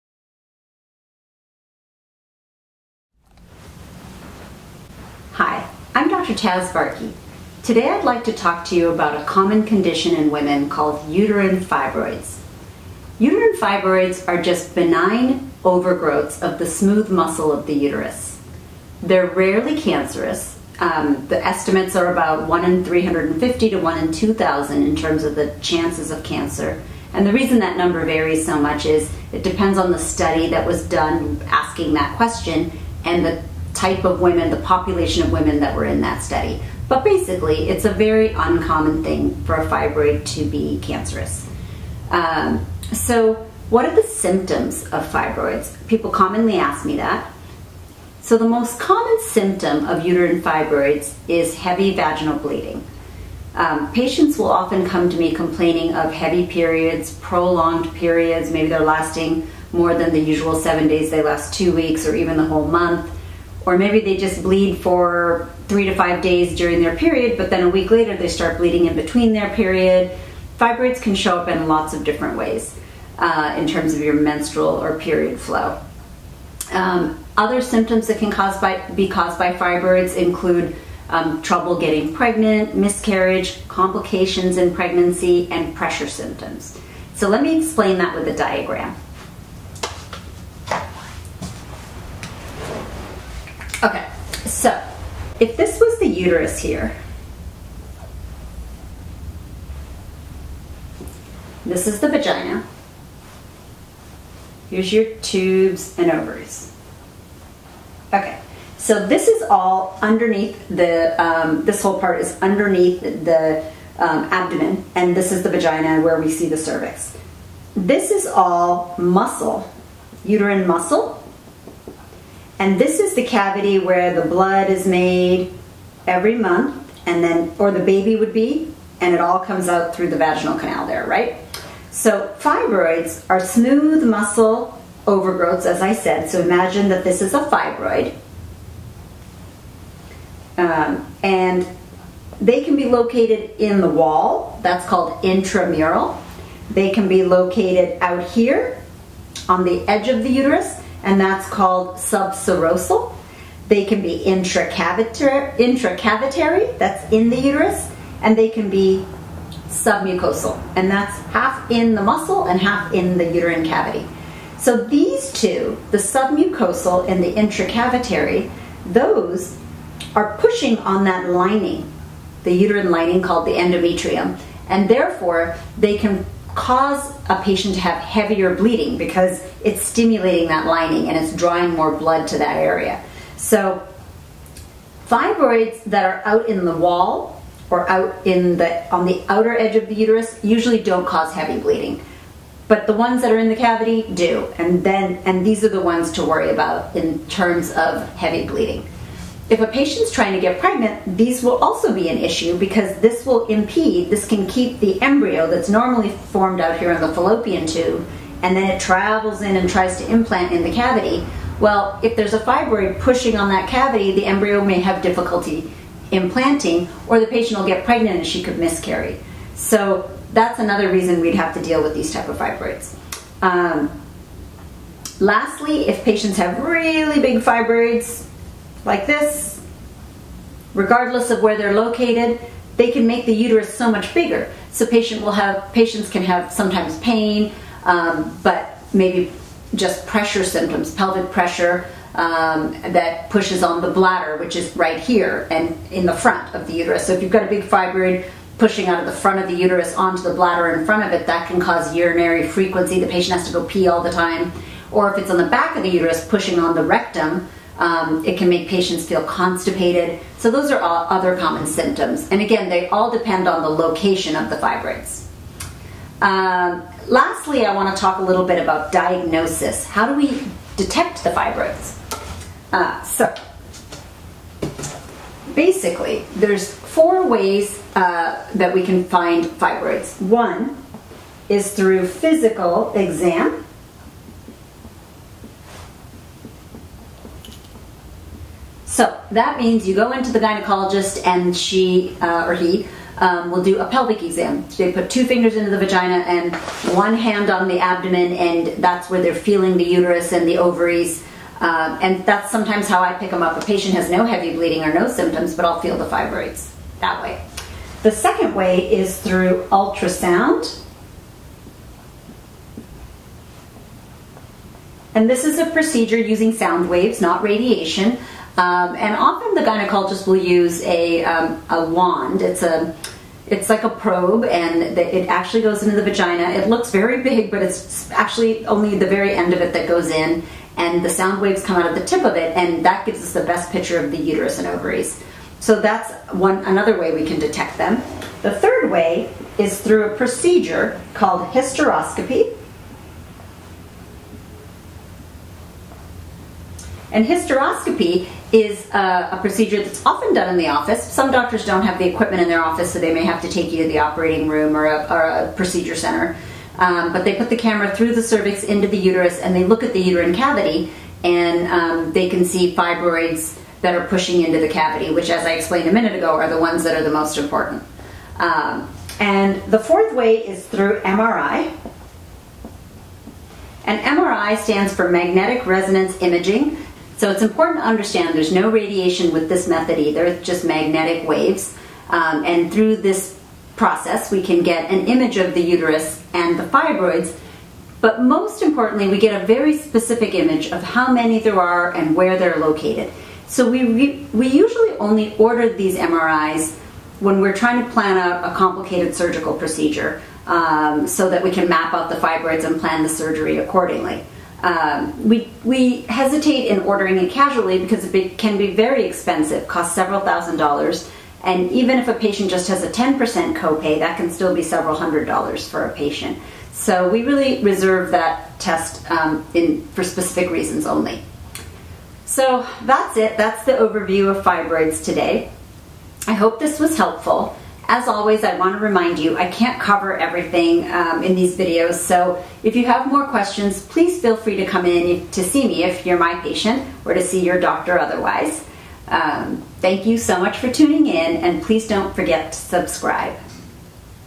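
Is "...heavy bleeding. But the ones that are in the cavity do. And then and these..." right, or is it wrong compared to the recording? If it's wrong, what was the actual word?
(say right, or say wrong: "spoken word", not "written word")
right.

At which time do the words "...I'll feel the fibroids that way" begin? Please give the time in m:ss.
5:05.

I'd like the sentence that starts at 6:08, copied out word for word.
Um, and the fourth way is through MRI.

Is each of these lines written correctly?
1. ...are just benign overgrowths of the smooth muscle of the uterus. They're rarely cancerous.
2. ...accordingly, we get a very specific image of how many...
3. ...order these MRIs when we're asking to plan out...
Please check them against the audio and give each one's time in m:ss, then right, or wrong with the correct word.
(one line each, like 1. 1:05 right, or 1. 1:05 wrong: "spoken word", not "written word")
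1. 0:14 right
2. 6:28 wrong: "importantly", not "accordingly"
3. 6:35 wrong: "trying", not "asking".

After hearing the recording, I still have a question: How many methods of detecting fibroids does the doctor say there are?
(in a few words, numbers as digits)
4.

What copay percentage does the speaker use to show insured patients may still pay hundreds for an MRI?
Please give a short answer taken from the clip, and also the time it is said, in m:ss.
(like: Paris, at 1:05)
10%, at 6:52.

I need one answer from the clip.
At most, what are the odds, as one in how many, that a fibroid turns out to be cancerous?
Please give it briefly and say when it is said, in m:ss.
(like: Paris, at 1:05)
1 in 2,000, at 0:23.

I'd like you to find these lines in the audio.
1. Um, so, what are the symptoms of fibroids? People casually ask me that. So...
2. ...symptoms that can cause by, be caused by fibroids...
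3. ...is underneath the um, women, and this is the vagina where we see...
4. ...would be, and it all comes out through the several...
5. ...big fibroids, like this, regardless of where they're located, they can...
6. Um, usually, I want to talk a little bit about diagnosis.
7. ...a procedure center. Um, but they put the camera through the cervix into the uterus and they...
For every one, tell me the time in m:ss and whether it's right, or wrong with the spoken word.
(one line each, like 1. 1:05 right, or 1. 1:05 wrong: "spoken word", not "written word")
1. 0:42 wrong: "commonly", not "casually"
2. 1:17 right
3. 1:52 wrong: "abdomen", not "women"
4. 2:08 wrong: "vaginal", not "several"
5. 3:47 right
6. 4:26 wrong: "lastly", not "usually"
7. 5:55 right.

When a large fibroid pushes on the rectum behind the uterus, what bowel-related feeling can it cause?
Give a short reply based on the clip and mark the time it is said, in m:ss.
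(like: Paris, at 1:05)
constipated, at 4:19.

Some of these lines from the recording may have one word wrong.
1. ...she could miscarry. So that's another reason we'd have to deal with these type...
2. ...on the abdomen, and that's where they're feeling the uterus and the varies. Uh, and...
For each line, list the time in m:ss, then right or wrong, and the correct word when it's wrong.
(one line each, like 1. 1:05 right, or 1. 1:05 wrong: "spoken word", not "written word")
1. 3:38 right
2. 4:57 wrong: "ovaries", not "varies".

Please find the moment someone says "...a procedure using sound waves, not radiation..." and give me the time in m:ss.
5:15.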